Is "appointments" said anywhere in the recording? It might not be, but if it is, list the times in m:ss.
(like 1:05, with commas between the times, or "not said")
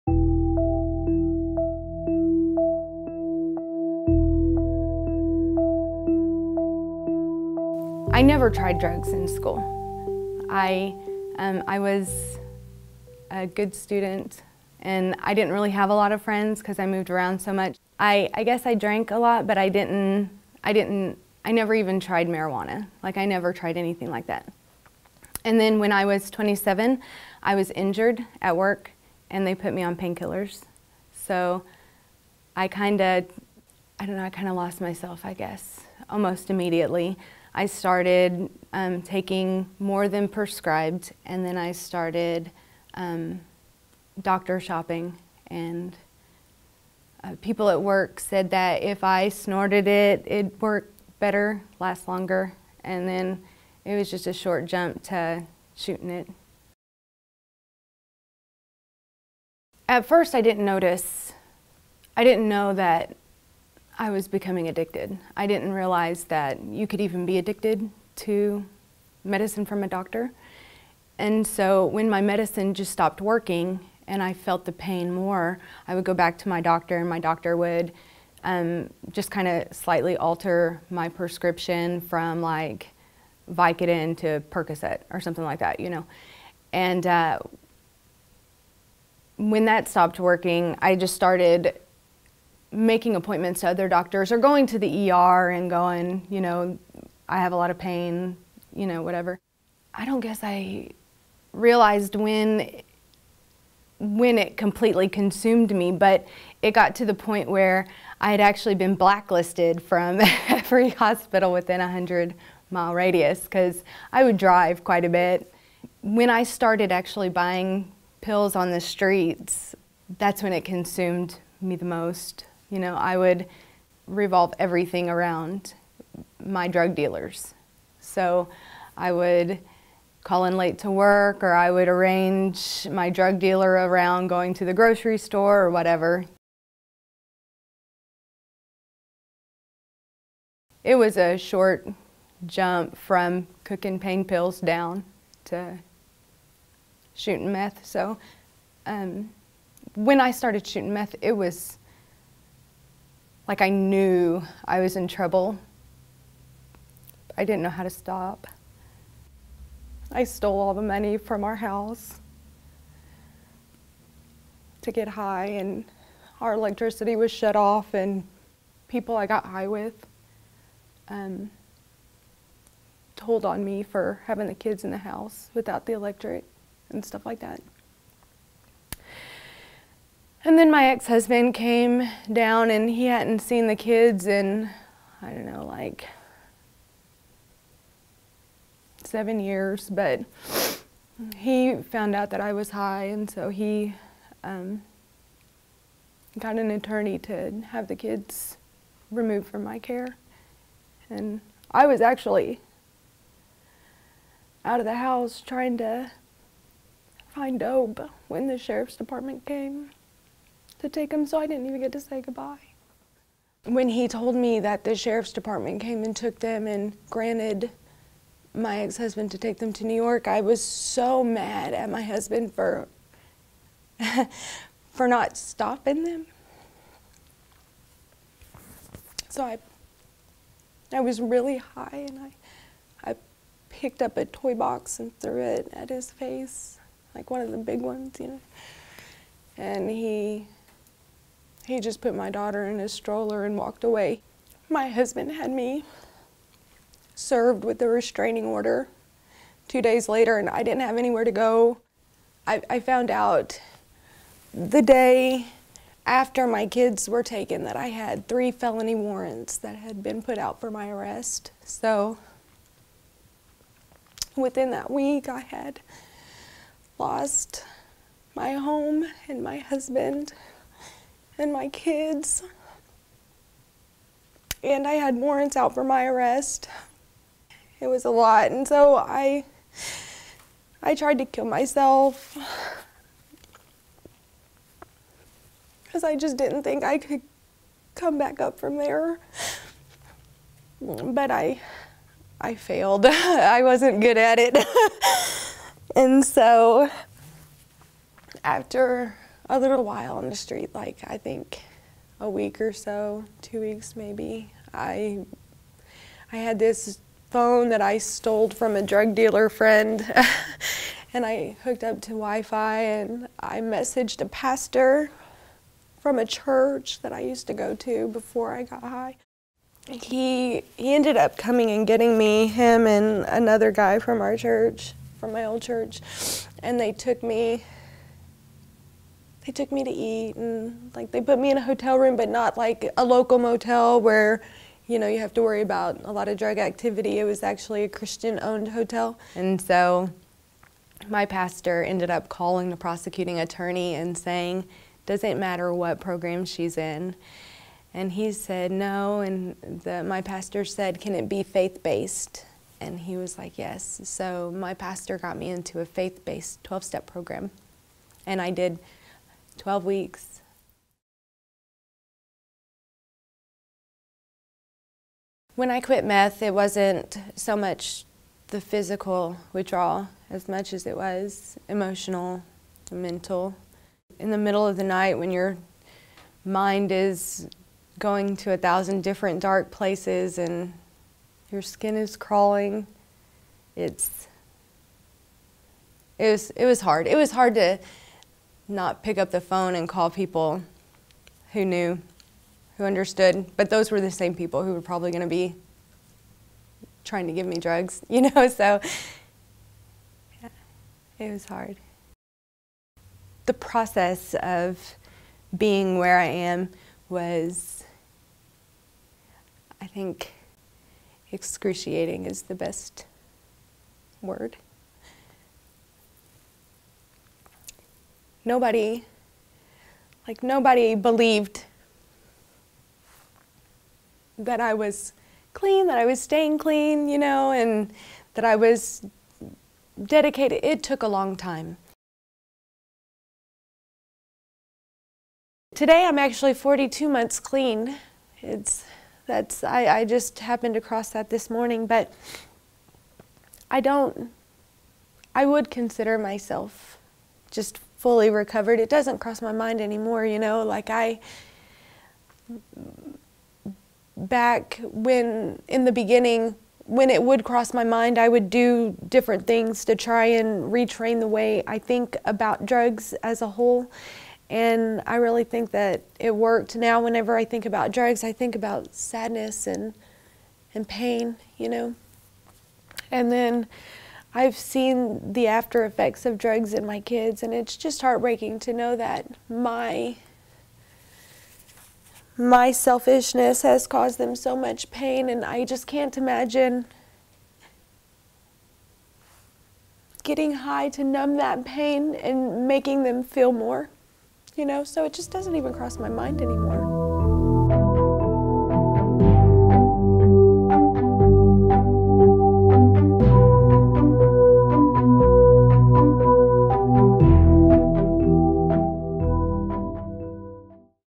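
1:33.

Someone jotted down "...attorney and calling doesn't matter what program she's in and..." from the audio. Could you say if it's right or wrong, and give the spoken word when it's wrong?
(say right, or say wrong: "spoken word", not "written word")
wrong: "saying", not "calling".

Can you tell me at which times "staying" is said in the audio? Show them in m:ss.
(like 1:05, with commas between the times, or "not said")
7:06.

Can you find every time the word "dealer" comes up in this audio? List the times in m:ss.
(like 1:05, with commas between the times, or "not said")
2:06, 2:13, 5:09.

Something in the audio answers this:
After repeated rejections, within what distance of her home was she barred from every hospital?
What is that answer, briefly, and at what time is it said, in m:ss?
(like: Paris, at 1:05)
100 miles, at 1:51.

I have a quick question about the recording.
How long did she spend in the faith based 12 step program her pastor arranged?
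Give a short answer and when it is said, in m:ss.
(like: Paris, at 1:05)
12 weeks, at 5:59.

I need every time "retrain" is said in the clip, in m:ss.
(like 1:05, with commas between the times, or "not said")
7:40.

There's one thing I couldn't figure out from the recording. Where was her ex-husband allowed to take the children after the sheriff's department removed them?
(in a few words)
New York.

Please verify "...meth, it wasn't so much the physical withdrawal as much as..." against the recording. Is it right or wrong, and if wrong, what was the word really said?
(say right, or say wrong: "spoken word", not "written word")
right.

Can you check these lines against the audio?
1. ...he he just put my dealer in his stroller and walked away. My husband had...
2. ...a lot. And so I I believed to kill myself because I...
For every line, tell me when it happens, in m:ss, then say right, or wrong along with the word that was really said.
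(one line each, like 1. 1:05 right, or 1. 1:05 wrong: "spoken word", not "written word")
1. 3:59 wrong: "daughter", not "dealer"
2. 4:38 wrong: "tried", not "believed".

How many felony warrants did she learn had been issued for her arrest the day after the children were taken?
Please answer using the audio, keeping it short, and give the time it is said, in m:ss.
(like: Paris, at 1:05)
3, at 4:18.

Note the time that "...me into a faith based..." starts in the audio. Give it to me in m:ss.
5:55.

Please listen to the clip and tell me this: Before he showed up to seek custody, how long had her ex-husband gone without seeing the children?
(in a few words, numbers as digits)
7 years.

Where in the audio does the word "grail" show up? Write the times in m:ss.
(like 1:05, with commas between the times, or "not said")
not said.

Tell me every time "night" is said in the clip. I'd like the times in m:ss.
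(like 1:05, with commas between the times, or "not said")
6:14.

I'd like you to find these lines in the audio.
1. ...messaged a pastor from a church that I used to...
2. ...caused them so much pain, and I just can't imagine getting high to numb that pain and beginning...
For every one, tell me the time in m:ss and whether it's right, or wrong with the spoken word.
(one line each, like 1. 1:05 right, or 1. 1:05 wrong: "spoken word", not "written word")
1. 5:13 right
2. 8:03 wrong: "making", not "beginning".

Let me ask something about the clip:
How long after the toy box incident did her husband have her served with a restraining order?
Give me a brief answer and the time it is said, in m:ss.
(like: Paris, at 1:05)
2 days later, at 4:09.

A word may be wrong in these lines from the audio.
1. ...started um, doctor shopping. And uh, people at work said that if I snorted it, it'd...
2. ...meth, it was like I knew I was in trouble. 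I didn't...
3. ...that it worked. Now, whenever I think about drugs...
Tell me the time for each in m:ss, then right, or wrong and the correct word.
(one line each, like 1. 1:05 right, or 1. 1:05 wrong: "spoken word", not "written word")
1. 0:41 right
2. 2:30 right
3. 7:45 right.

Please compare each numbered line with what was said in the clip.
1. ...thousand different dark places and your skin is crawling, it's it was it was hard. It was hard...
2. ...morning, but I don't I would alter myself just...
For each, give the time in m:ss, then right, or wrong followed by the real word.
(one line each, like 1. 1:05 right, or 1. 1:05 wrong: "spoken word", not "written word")
1. 6:18 right
2. 7:21 wrong: "consider", not "alter".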